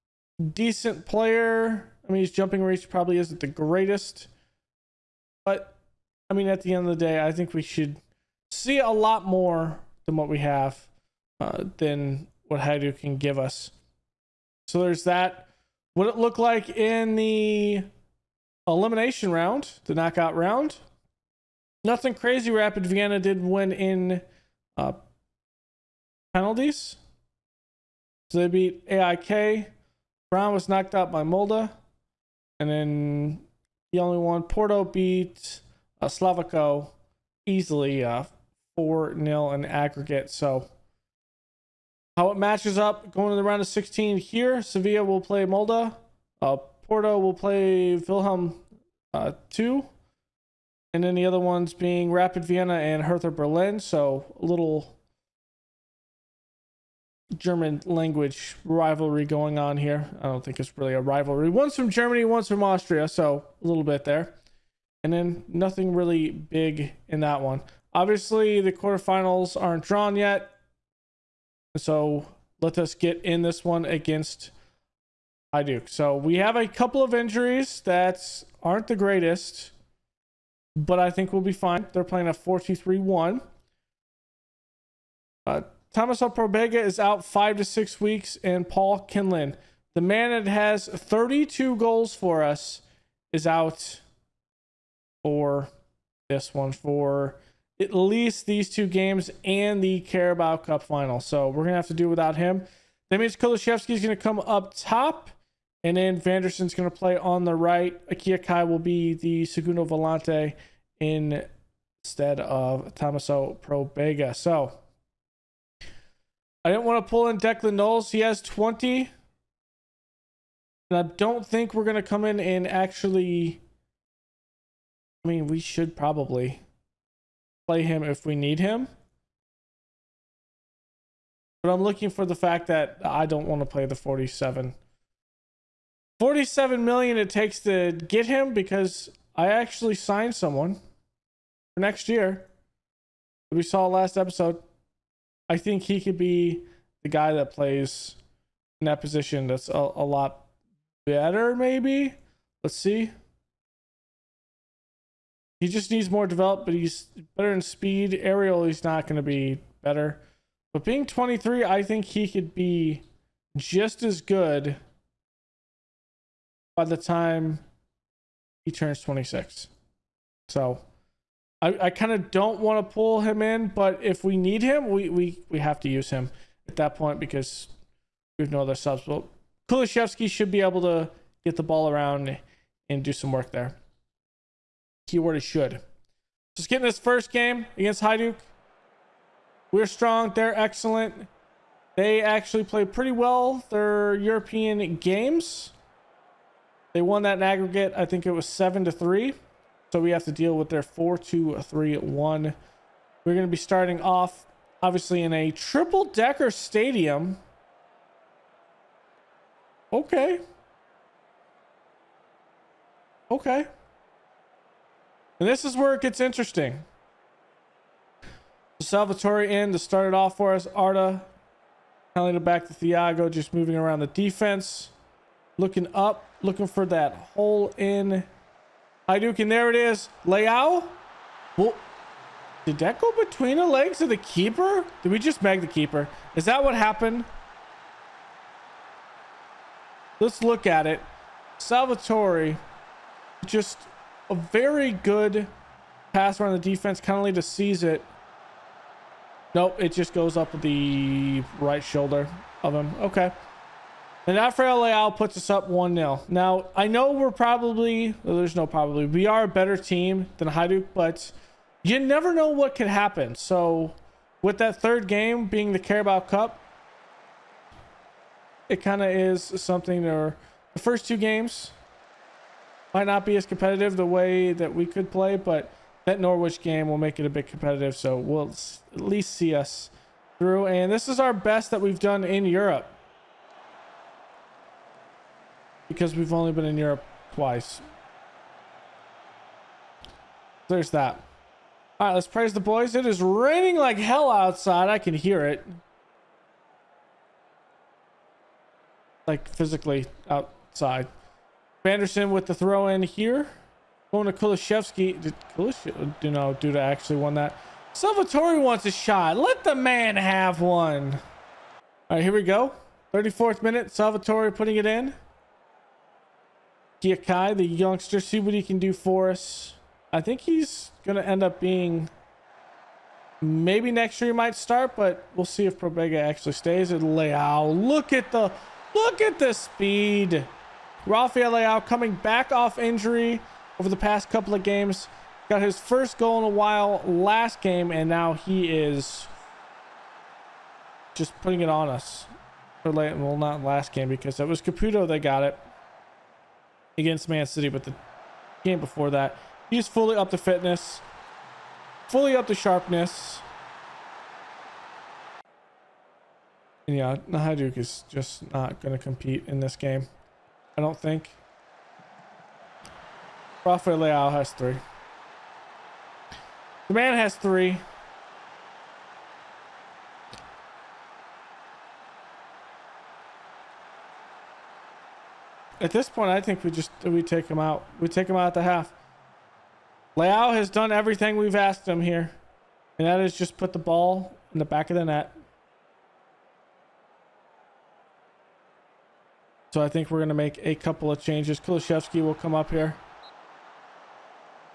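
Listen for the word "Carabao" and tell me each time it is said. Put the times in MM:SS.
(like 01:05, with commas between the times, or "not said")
01:39, 04:25.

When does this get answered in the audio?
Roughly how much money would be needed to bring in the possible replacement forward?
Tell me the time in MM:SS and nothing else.
02:16.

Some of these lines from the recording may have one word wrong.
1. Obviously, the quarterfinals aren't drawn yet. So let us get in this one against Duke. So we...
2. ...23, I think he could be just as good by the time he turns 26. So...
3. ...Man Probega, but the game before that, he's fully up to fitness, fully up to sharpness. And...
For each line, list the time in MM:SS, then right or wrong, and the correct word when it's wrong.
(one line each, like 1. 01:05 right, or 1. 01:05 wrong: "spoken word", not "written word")
1. 01:07 right
2. 02:41 right
3. 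05:47 wrong: "City", not "Probega".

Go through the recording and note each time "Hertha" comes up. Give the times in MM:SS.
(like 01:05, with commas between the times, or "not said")
00:53.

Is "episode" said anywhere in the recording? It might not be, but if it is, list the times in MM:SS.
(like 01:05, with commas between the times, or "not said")
02:24.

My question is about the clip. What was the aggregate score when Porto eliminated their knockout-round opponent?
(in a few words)
4-0.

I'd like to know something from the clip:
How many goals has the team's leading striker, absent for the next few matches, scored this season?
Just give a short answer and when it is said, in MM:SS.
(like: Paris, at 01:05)
32, at 01:30.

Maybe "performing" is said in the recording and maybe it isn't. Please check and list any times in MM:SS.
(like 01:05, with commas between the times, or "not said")
not said.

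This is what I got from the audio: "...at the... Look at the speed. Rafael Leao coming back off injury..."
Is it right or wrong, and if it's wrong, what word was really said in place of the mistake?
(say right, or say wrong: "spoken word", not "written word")
right.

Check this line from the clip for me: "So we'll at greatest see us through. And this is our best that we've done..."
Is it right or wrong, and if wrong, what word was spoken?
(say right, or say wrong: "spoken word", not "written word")
wrong: "least", not "greatest".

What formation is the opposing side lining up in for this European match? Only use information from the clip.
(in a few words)
4-2-3-1.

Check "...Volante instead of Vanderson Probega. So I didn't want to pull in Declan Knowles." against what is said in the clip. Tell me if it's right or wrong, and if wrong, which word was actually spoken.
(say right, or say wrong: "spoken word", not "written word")
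wrong: "Tomaso", not "Vanderson".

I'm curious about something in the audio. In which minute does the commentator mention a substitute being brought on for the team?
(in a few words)
34th minute.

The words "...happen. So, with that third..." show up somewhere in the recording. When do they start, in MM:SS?
04:22.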